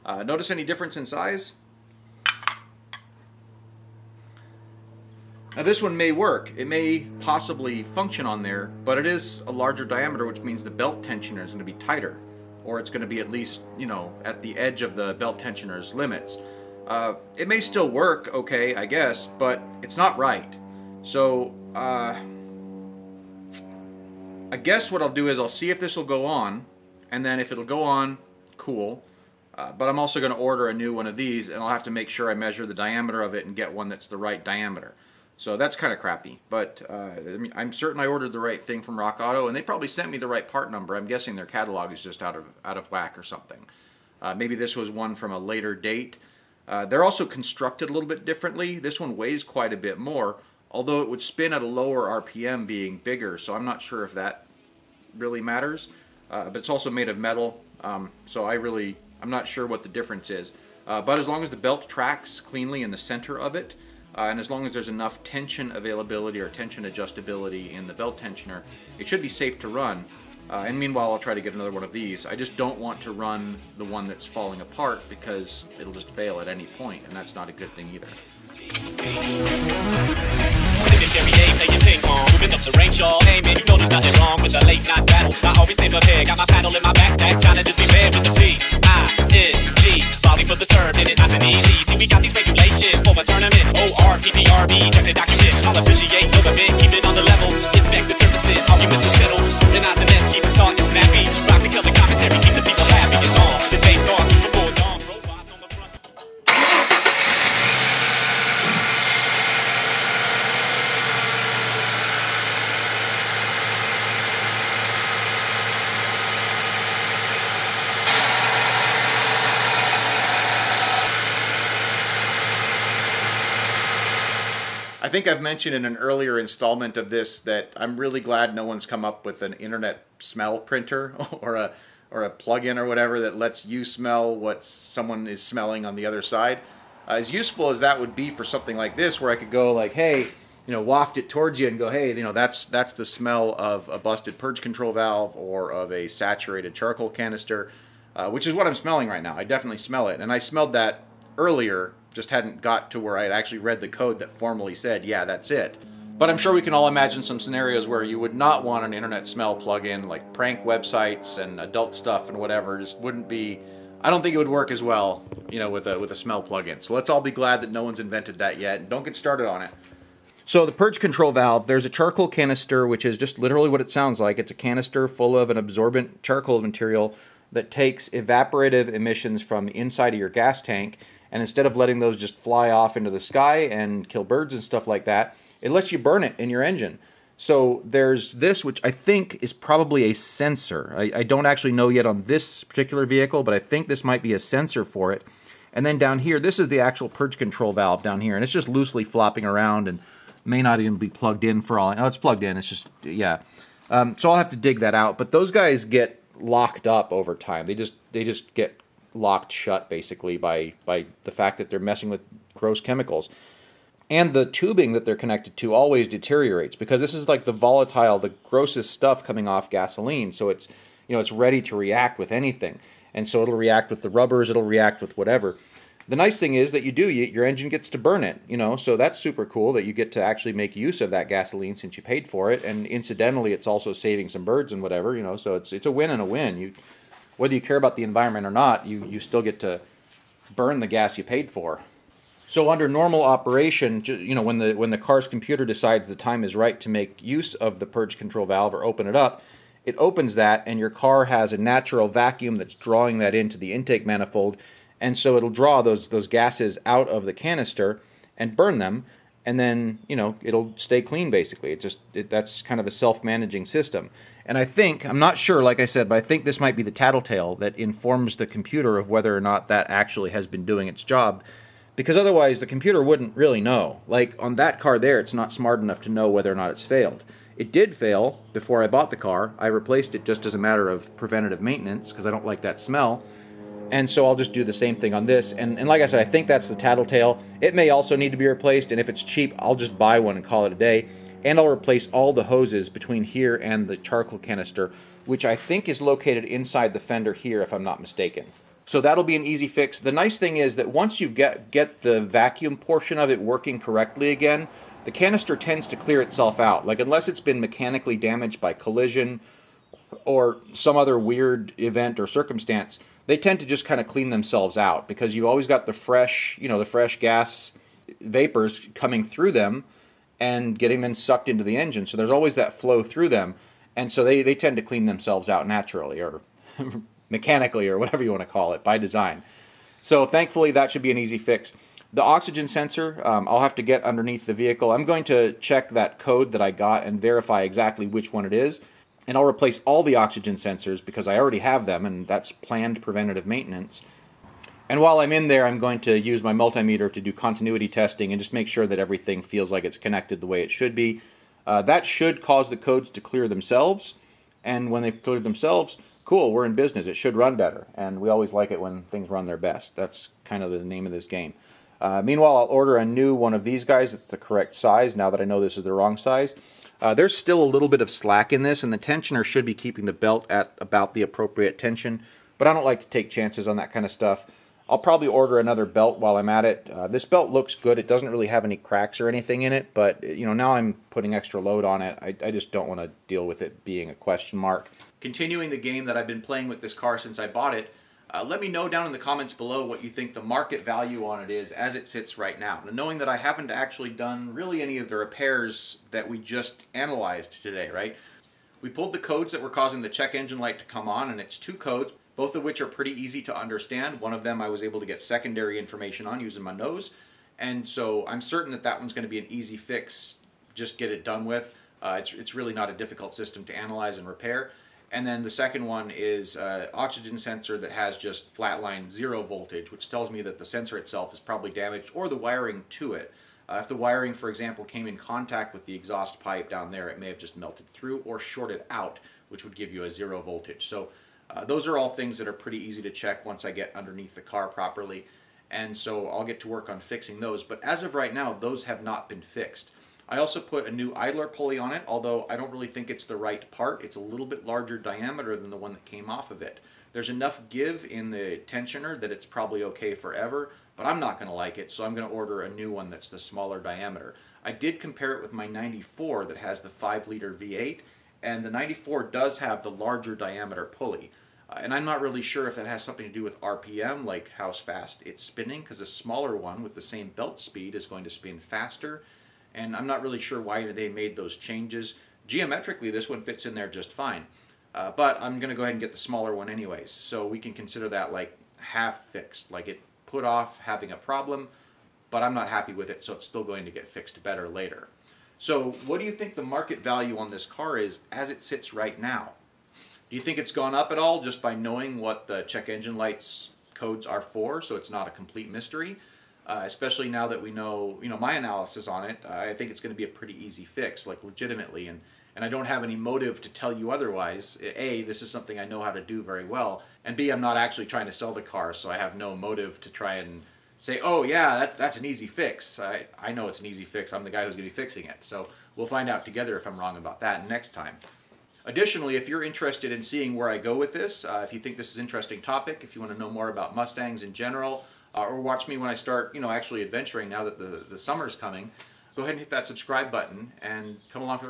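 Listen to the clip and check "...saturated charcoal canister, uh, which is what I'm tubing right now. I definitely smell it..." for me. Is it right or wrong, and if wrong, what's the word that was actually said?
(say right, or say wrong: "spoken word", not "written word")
wrong: "smelling", not "tubing".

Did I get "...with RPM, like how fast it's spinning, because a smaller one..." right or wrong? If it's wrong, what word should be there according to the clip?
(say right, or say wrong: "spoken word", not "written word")
right.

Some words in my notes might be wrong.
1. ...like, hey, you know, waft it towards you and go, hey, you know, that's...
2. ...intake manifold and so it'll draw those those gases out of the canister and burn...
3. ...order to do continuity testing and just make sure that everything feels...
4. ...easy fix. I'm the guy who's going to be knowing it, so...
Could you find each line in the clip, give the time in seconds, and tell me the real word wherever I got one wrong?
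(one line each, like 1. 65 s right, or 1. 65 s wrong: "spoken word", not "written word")
1. 139 s right
2. 253 s right
3. 346 s wrong: "multimeter", not "order"
4. 513 s wrong: "fixing", not "knowing".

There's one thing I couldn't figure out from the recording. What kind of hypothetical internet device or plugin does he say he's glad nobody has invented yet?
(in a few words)
internet smell printer.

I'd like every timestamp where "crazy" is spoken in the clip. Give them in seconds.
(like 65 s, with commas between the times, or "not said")
not said.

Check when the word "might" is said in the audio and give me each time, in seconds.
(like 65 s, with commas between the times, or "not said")
194 s, 266 s.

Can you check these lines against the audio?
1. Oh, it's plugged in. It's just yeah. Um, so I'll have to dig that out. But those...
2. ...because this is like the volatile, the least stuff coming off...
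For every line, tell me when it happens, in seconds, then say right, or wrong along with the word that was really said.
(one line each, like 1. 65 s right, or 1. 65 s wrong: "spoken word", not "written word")
1. 201 s right
2. 216 s wrong: "grossest", not "least".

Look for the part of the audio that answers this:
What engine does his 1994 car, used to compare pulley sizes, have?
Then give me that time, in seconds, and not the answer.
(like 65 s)
456 s.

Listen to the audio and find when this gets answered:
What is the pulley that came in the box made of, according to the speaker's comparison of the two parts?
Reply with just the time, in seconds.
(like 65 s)
57 s.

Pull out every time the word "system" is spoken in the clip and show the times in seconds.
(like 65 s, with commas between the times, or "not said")
263 s, 413 s.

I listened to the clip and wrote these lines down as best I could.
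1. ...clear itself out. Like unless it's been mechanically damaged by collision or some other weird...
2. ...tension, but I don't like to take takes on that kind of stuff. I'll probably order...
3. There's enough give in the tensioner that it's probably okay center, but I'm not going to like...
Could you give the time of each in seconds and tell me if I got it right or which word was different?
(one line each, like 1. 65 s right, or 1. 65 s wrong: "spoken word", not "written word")
1. 305 s right
2. 371 s wrong: "chances", not "takes"
3. 447 s wrong: "forever", not "center".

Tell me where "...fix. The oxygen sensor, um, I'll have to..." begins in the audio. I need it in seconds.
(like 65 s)
331 s.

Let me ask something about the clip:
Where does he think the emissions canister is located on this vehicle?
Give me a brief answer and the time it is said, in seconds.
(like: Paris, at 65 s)
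inside the fender, at 296 s.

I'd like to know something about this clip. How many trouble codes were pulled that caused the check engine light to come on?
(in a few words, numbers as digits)
2.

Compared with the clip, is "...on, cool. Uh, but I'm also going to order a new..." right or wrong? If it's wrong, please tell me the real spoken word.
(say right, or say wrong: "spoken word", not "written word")
right.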